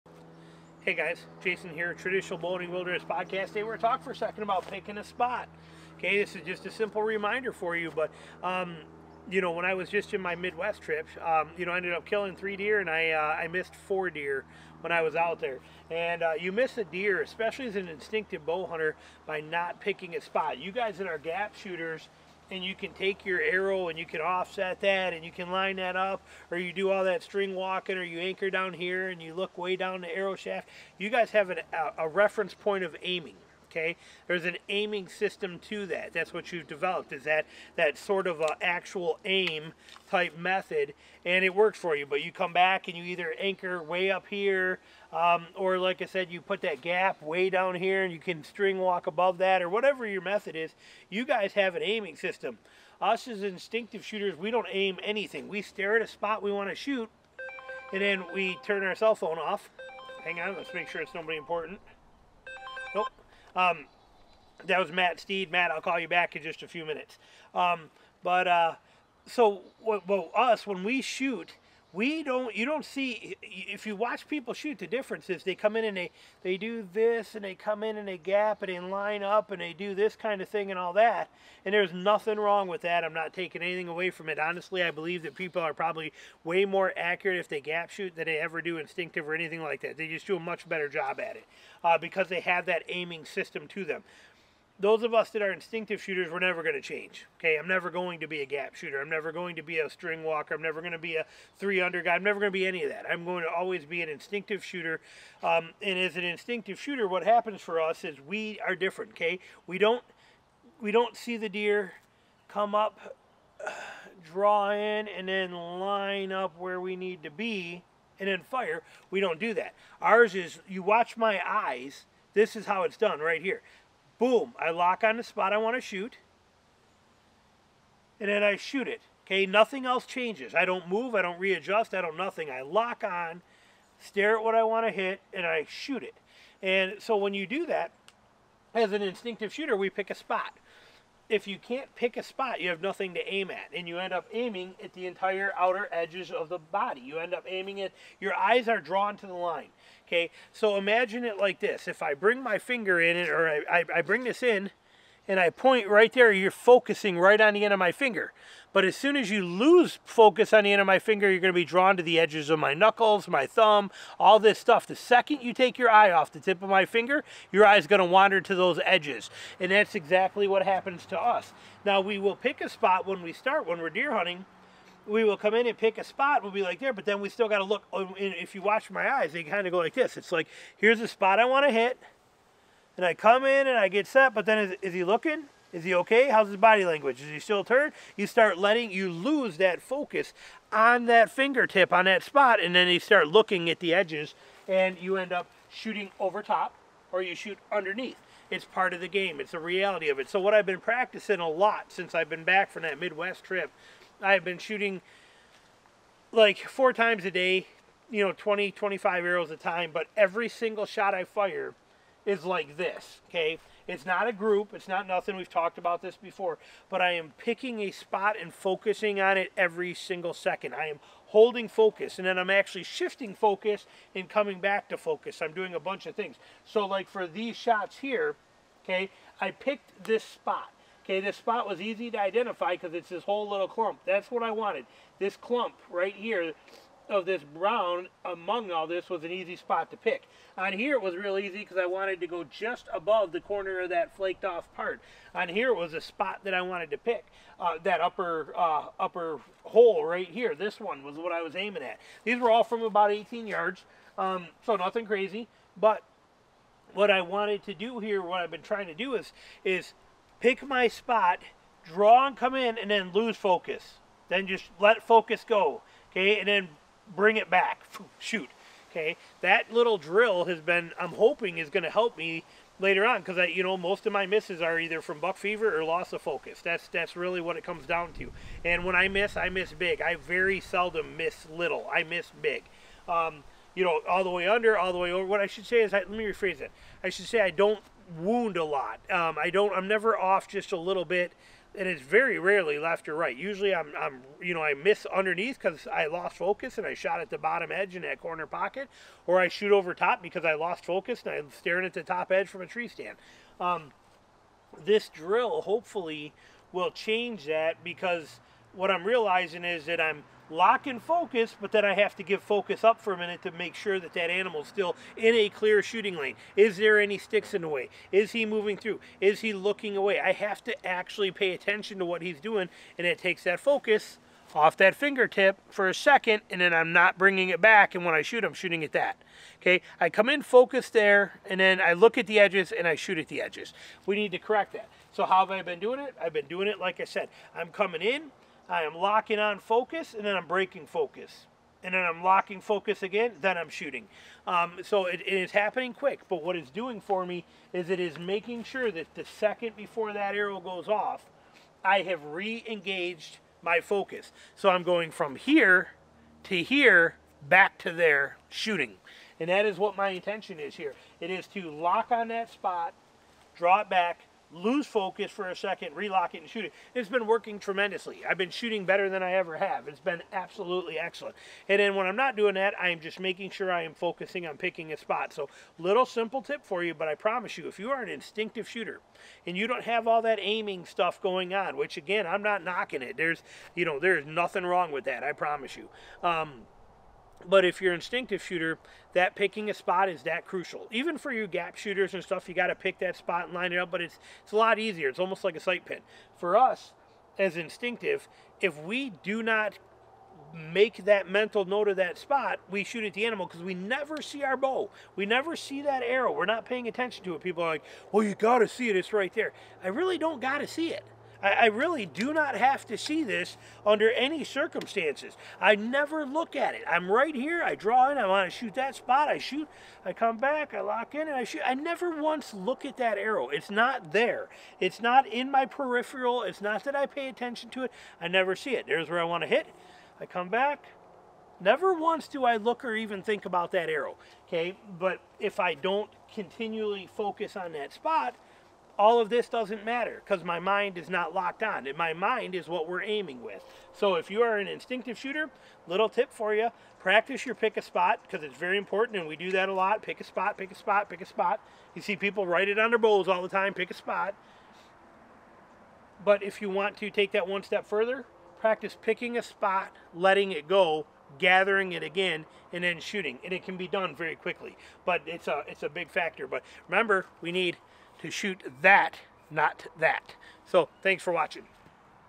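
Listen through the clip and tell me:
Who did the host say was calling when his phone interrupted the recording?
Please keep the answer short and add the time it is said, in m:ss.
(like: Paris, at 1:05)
Matt Steed, at 1:04.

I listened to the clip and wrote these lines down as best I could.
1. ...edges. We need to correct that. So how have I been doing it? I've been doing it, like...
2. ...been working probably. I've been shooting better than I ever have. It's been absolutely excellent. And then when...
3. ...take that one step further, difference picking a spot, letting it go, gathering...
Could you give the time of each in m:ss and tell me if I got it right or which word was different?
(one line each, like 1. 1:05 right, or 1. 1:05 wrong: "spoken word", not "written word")
1. 5:33 right
2. 6:07 wrong: "tremendously", not "probably"
3. 7:37 wrong: "practice", not "difference".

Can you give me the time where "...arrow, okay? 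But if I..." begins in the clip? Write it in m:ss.
7:13.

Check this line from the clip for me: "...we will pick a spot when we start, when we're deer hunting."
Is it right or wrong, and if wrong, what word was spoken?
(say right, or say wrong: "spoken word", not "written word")
right.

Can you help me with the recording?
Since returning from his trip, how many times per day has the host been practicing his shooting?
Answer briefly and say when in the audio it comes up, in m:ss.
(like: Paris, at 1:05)
4 times a day, at 3:26.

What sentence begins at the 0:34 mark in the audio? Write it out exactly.
There's an aiming system to that.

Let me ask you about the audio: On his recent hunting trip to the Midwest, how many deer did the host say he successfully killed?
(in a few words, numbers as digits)
3.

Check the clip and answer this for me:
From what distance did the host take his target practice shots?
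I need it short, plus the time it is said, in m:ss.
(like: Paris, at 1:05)
18 yards, at 4:13.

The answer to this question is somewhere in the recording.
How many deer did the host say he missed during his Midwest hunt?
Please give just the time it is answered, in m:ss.
0:13.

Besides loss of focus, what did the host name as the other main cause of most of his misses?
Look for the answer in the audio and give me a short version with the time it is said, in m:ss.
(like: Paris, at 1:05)
Buck fever, at 4:35.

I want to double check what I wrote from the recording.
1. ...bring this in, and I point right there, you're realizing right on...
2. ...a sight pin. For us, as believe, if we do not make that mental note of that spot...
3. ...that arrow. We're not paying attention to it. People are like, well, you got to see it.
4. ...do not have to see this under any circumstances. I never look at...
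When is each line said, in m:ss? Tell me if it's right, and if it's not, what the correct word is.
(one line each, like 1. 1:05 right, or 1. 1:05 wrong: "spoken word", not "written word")
1. 2:34 wrong: "focusing", not "realizing"
2. 6:35 wrong: "instinctive", not "believe"
3. 6:45 right
4. 6:52 right.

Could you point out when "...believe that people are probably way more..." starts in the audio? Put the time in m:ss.
1:24.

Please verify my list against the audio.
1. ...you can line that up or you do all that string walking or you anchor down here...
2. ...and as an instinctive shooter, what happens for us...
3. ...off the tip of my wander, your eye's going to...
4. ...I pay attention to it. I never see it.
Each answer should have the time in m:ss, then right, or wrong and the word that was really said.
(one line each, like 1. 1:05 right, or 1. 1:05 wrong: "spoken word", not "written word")
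1. 0:25 right
2. 1:45 right
3. 2:46 wrong: "finger", not "wander"
4. 7:06 right.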